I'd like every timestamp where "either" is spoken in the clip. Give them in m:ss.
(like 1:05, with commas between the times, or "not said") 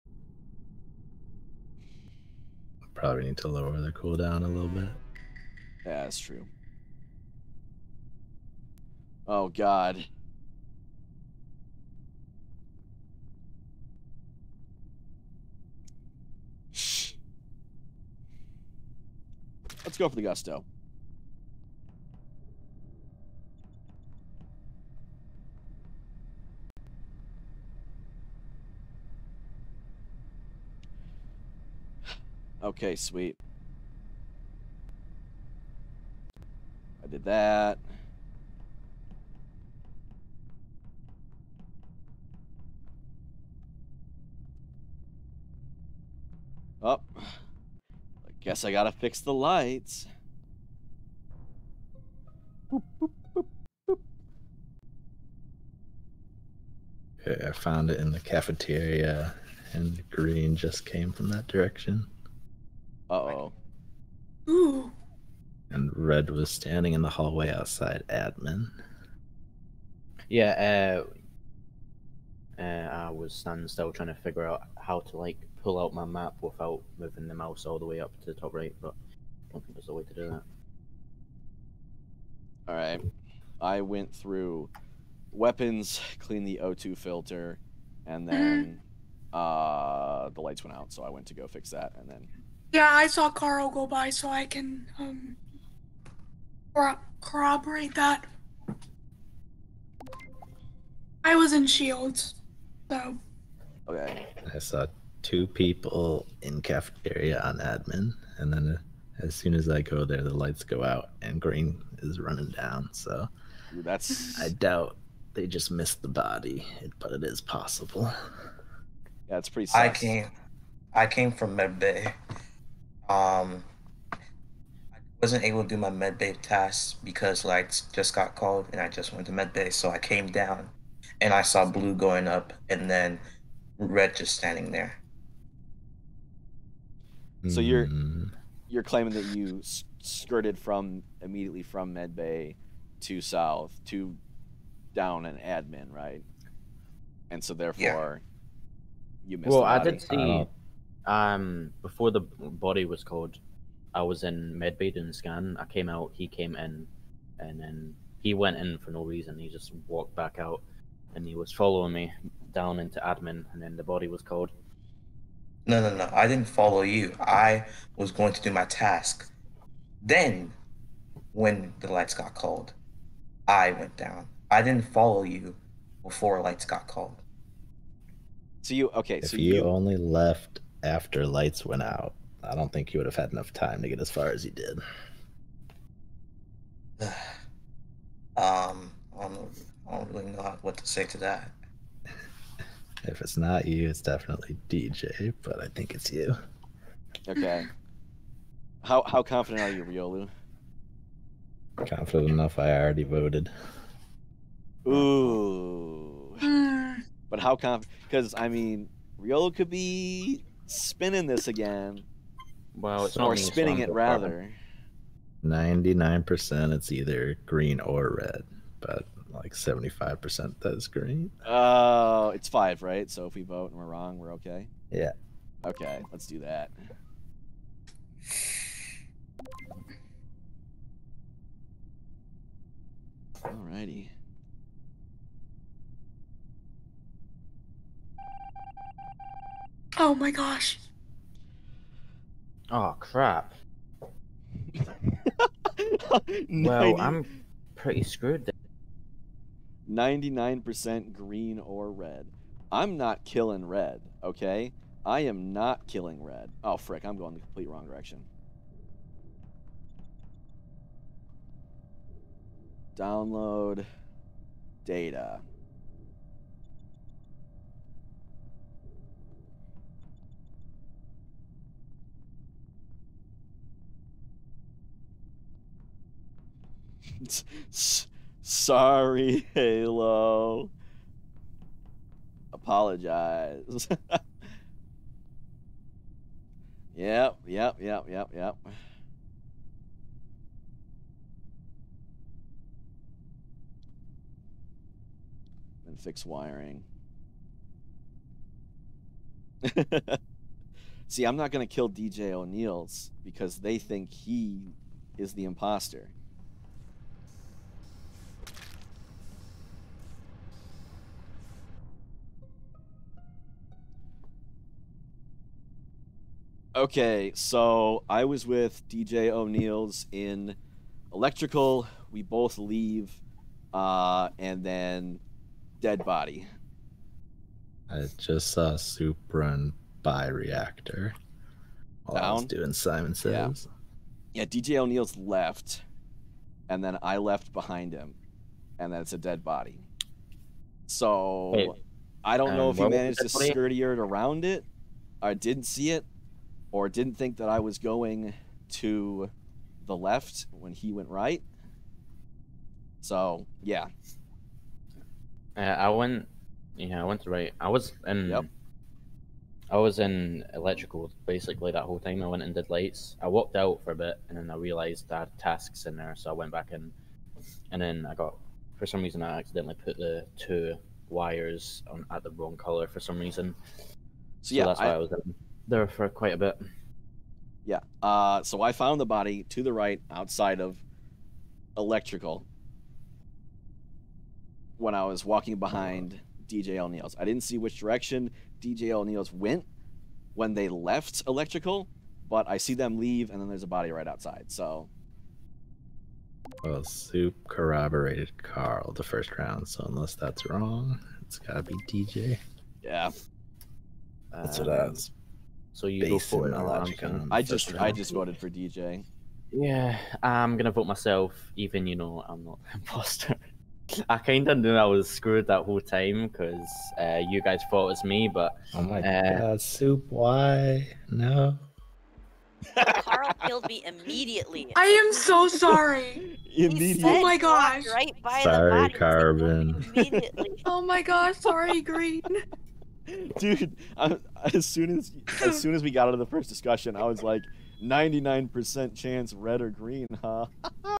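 3:36.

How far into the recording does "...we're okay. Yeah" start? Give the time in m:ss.
3:44.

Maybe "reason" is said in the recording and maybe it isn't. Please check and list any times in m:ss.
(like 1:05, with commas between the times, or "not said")
2:39, 6:09, 6:13.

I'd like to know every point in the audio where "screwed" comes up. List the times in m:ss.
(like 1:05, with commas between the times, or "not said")
4:08, 6:55.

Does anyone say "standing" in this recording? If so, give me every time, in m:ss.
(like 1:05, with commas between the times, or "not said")
1:06, 1:13, 2:14.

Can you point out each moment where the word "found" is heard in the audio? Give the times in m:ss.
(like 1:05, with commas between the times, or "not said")
0:57, 6:18.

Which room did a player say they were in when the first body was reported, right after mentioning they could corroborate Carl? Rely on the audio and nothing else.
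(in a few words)
Shields.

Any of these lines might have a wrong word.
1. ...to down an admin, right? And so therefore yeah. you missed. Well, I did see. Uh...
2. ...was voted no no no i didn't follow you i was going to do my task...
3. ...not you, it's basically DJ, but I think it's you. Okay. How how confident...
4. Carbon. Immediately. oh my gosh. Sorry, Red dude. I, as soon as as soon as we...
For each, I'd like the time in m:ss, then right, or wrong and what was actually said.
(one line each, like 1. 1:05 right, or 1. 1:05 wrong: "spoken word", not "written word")
1. 2:23 right
2. 2:44 wrong: "called", not "voted"
3. 3:13 wrong: "definitely", not "basically"
4. 7:08 wrong: "Green", not "Red".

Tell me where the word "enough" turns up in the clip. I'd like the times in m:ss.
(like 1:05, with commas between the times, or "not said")
3:03, 3:22.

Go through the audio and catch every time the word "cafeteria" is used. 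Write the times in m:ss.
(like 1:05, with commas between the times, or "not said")
0:58, 1:46.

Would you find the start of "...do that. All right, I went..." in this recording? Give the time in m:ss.
1:20.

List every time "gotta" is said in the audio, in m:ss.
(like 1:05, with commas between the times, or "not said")
0:48, 6:41.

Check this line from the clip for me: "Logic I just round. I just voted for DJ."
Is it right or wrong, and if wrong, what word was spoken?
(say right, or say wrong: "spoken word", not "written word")
right.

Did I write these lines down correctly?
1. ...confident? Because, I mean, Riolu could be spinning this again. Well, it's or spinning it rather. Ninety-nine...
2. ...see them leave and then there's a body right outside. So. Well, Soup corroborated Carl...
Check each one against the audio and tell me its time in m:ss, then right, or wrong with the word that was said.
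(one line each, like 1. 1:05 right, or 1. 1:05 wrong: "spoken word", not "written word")
1. 3:27 right
2. 6:32 right.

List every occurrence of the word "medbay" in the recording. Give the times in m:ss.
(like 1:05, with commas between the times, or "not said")
2:01, 2:34.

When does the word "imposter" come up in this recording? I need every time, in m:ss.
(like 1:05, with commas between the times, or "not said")
5:05, 6:52.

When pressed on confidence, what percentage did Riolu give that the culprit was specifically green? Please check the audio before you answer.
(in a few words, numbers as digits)
75%.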